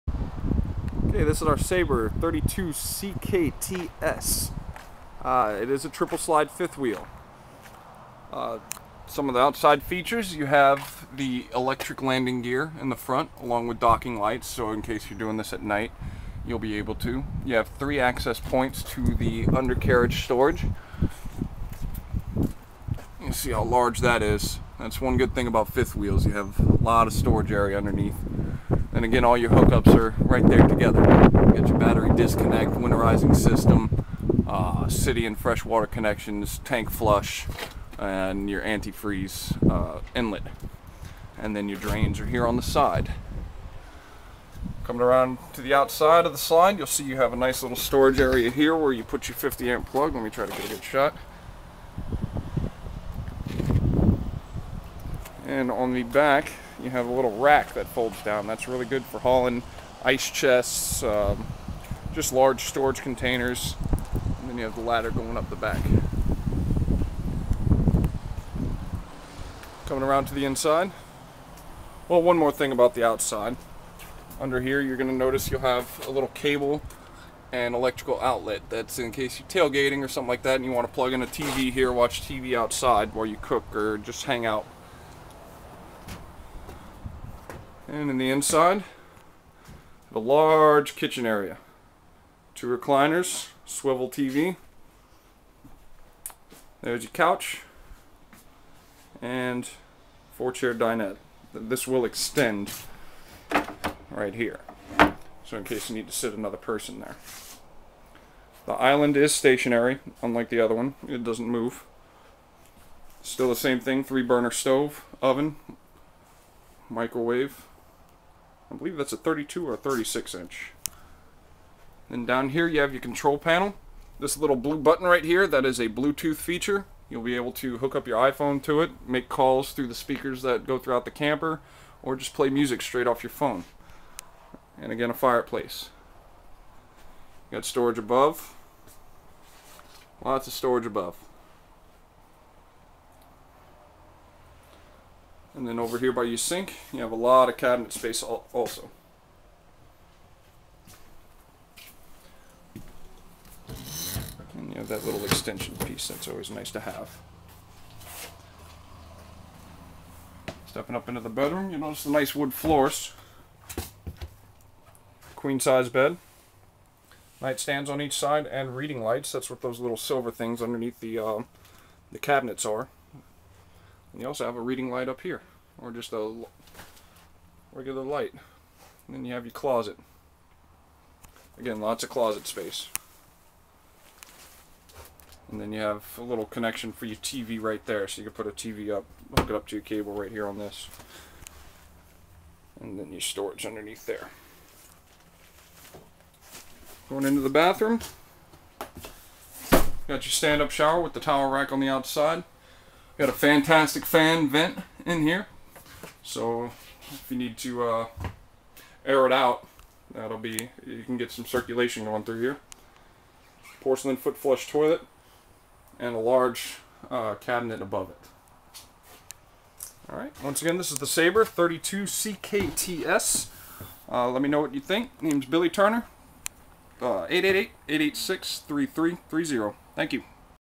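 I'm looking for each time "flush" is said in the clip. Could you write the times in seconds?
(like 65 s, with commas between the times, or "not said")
36 s, 214 s.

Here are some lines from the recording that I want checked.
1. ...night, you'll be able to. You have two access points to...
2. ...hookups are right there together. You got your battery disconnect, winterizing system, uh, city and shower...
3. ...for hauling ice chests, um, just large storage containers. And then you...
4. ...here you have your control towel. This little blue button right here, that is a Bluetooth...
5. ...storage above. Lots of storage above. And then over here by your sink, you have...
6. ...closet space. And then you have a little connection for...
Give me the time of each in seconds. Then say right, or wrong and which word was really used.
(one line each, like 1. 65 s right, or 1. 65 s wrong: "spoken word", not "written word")
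1. 15 s wrong: "three", not "two"
2. 29 s wrong: "freshwater", not "shower"
3. 59 s right
4. 122 s wrong: "panel", not "towel"
5. 137 s right
6. 182 s right.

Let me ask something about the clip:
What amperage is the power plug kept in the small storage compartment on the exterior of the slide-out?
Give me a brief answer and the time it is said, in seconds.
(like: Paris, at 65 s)
50 amp, at 49 s.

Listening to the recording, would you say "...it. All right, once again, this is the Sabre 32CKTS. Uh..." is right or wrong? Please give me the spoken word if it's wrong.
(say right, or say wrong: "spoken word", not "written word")
right.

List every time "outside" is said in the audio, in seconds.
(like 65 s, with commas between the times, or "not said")
9 s, 45 s, 73 s, 82 s, 201 s.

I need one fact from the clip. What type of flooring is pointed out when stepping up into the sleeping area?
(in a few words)
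Wood floors.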